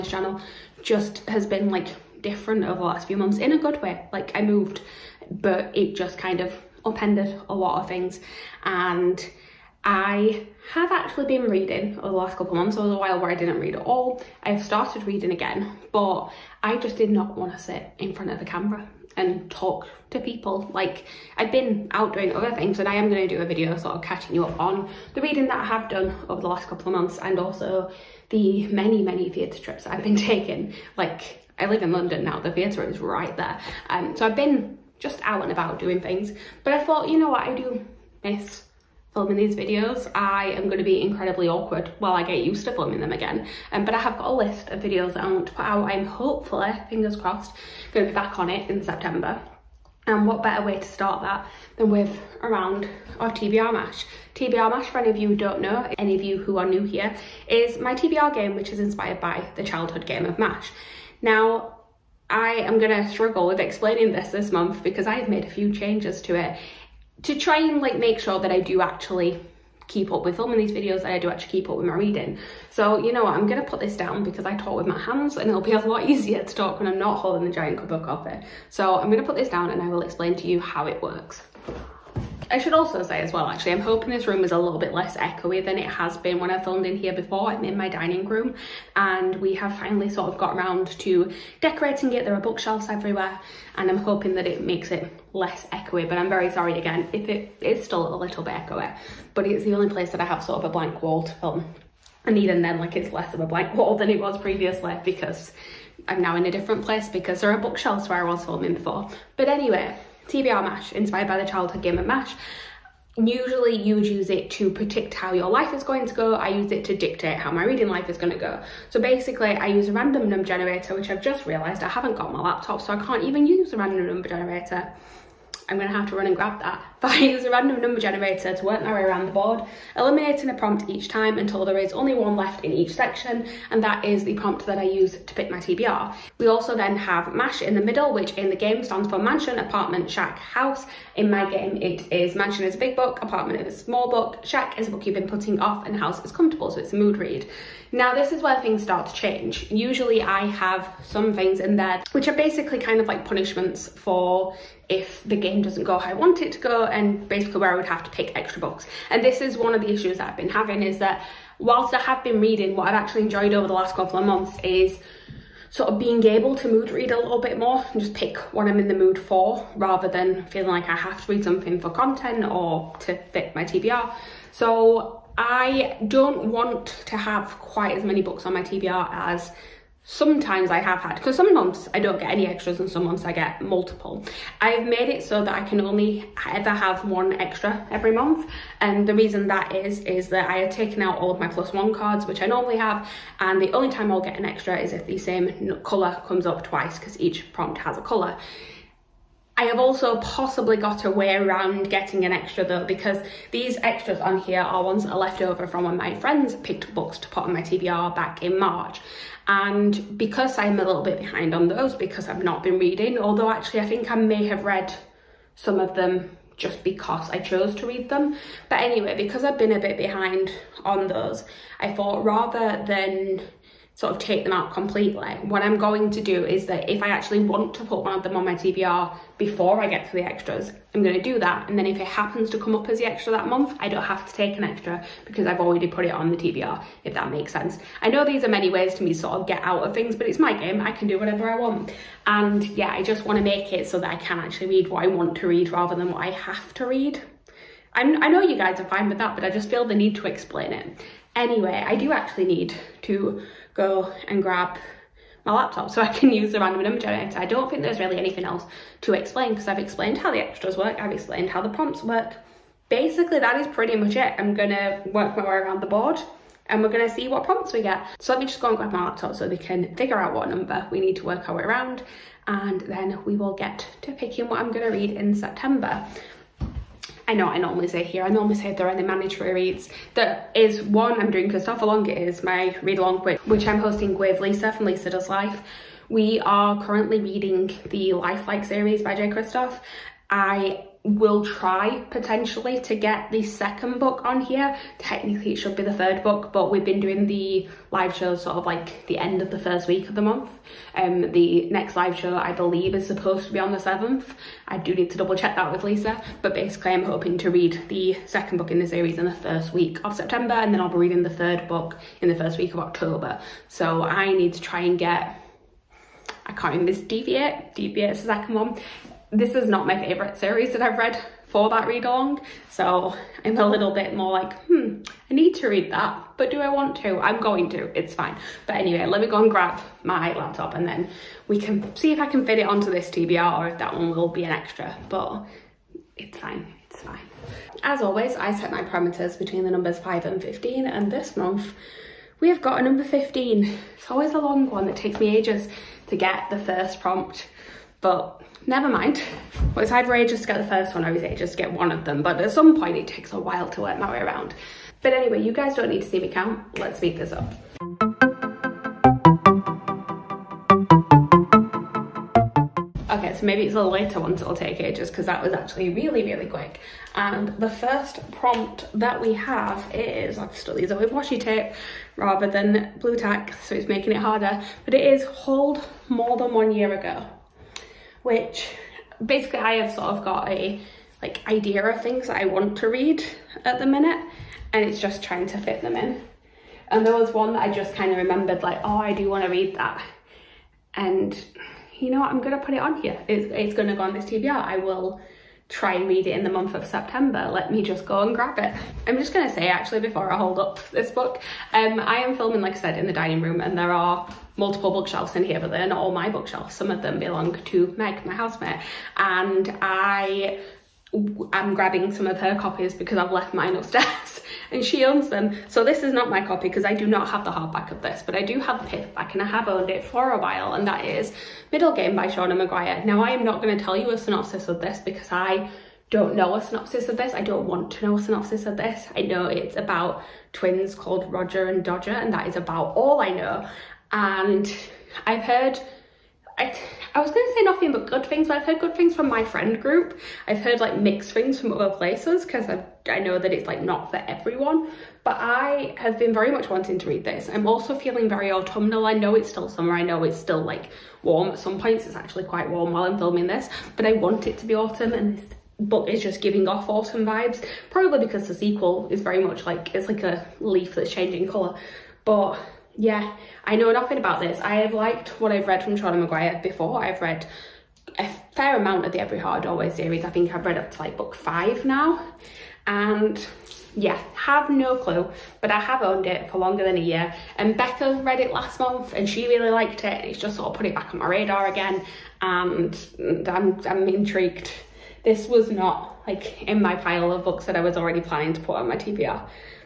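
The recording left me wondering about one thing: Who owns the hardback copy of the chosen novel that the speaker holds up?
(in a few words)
Meg.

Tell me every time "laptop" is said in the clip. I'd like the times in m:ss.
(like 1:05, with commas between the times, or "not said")
2:02, 4:15, 4:29, 5:30.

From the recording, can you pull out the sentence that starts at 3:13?
And the only time I'll get an extra is if the same color comes up twice because each prompt has a color.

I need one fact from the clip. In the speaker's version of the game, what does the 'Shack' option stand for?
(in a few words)
a book you've been putting off.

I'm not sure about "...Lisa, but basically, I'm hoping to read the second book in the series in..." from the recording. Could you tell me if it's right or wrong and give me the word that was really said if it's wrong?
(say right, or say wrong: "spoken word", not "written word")
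right.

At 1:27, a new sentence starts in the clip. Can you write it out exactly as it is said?
I'm in my dining room and we have finally sort of got around to decorating it.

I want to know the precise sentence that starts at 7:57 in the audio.
And Becca read it last month and she really liked it.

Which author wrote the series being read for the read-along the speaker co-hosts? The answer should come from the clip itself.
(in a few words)
Jay Kristoff.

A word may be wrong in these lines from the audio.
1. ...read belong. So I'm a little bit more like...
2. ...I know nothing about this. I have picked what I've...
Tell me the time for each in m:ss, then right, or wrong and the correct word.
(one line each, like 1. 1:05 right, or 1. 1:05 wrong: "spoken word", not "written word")
1. 5:21 wrong: "along", not "belong"
2. 7:43 wrong: "liked", not "picked".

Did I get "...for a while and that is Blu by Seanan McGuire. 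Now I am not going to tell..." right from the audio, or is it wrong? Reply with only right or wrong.
wrong.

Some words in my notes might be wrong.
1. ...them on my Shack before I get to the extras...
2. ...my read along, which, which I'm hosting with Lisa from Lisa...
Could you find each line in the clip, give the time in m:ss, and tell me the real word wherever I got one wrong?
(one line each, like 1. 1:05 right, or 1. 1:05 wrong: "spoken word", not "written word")
1. 3:48 wrong: "TBR", not "Shack"
2. 4:42 right.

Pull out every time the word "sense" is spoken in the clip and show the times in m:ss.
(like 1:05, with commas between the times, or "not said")
3:57.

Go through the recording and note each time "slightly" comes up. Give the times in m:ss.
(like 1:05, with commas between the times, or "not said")
not said.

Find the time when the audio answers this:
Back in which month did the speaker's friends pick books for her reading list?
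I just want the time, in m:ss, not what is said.
3:28.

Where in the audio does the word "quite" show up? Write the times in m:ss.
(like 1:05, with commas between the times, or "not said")
2:57, 7:32.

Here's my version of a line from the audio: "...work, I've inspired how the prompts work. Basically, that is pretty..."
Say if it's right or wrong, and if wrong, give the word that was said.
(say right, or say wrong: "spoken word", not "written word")
wrong: "explained", not "inspired".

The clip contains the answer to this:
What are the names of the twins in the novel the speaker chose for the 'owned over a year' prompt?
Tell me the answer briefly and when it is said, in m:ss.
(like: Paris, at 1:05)
Roger and Dodger, at 7:11.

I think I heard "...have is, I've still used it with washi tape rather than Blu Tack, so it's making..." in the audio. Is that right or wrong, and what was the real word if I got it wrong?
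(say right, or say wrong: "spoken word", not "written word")
right.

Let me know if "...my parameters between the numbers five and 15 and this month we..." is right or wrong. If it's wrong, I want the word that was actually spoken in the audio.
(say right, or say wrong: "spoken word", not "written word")
right.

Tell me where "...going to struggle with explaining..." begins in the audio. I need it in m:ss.
1:02.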